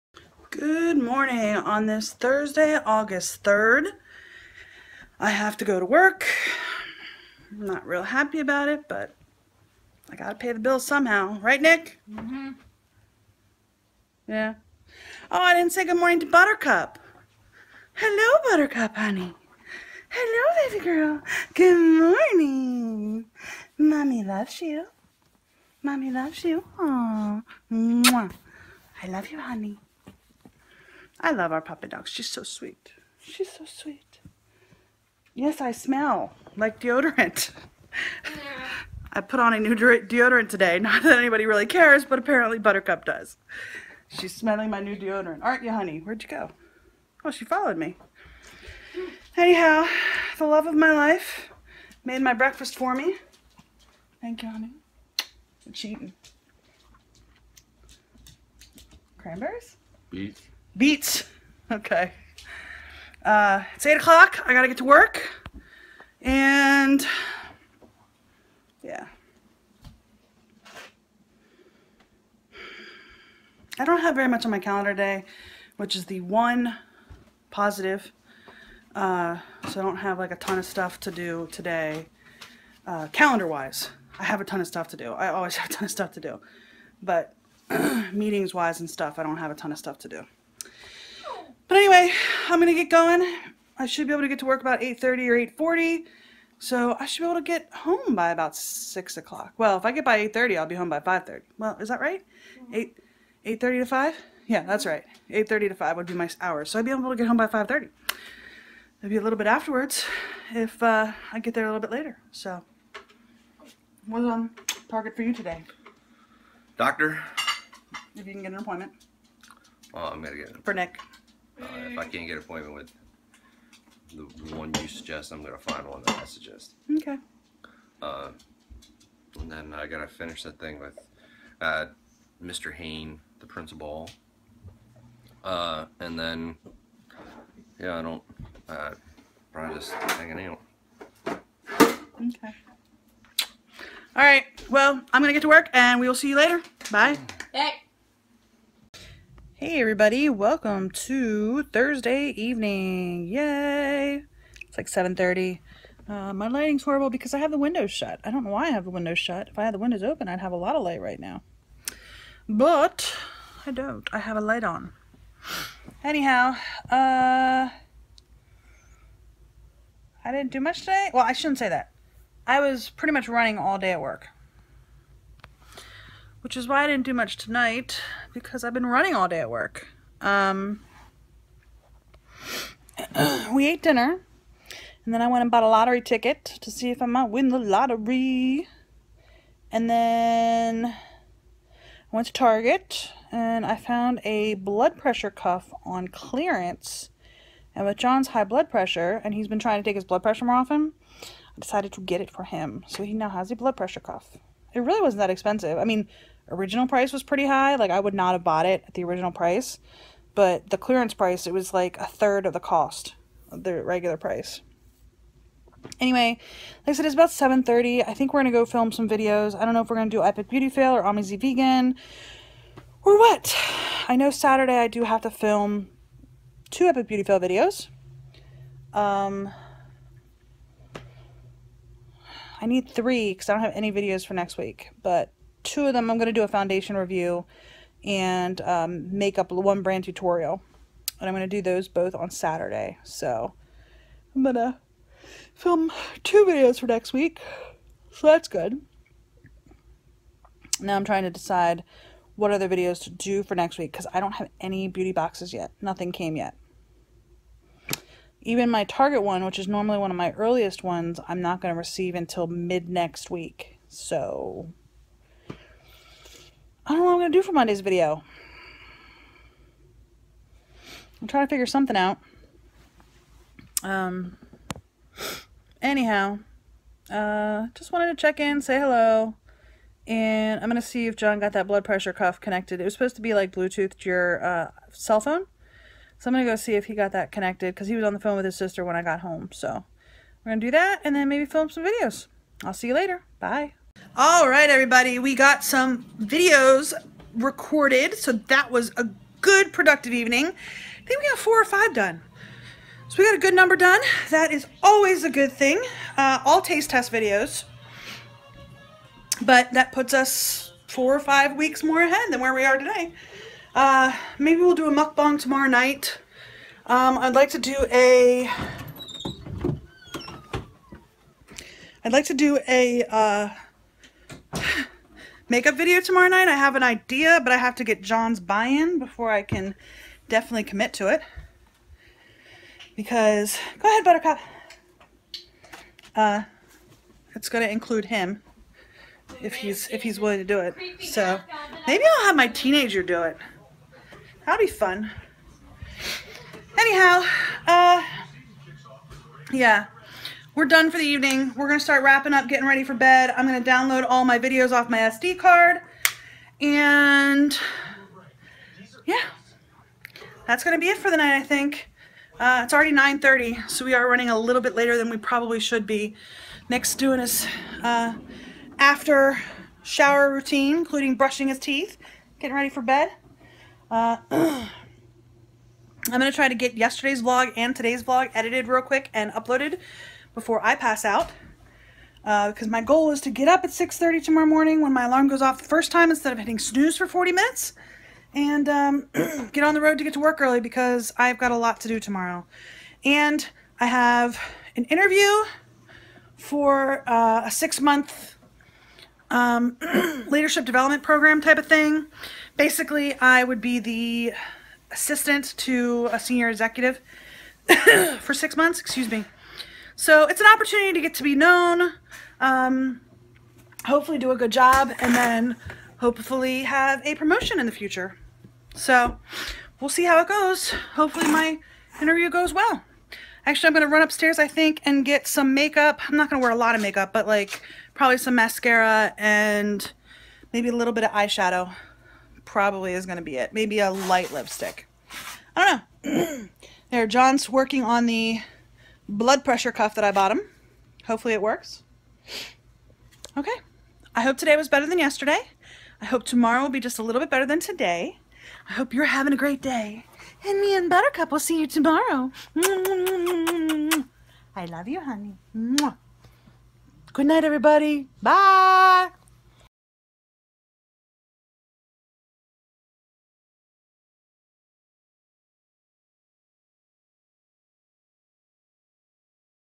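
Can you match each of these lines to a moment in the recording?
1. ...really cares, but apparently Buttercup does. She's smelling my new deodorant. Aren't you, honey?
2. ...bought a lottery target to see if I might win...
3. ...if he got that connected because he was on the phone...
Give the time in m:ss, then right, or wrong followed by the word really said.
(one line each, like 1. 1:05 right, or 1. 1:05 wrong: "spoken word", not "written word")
1. 0:41 right
2. 3:05 wrong: "ticket", not "target"
3. 4:46 right.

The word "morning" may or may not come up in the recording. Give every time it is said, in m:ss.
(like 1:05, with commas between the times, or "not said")
0:01, 0:15, 0:22, 6:24.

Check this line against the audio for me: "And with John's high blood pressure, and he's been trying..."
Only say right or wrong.
right.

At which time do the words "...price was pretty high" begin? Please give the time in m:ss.
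3:26.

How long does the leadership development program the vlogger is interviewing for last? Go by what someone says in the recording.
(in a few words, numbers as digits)
6 months.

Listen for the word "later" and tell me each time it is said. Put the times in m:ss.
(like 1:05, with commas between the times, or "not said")
1:51, 2:26, 4:52, 6:04.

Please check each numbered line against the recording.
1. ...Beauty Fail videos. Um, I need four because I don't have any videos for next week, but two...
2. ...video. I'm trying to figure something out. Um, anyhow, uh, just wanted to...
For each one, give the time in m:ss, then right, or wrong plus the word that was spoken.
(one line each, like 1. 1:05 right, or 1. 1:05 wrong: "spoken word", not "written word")
1. 3:47 wrong: "three", not "four"
2. 4:27 right.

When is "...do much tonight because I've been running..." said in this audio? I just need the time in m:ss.
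2:57.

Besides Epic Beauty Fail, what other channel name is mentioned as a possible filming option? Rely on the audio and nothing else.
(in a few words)
Amizy Vegan.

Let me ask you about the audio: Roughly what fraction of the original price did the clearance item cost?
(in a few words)
a third.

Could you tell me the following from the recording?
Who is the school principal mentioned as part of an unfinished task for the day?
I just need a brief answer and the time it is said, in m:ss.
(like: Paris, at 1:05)
Mr. Hain, at 2:12.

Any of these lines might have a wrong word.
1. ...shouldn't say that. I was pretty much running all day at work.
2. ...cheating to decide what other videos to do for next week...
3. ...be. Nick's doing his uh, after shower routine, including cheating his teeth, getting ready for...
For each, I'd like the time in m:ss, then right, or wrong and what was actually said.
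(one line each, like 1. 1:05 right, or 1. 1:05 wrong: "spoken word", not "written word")
1. 2:51 right
2. 4:11 wrong: "trying", not "cheating"
3. 6:05 wrong: "brushing", not "cheating".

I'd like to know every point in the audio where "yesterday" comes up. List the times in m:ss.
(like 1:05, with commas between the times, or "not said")
6:16, 7:24.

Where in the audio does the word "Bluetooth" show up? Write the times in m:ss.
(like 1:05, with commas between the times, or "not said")
4:43.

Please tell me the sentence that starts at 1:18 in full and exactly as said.
Uh, so I don't have like a ton of stuff to do today, uh, calendar-wise.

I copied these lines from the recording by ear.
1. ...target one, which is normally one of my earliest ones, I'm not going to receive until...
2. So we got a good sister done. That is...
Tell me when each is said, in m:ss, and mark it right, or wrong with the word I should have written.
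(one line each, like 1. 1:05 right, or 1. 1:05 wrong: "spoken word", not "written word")
1. 4:18 right
2. 5:03 wrong: "number", not "sister".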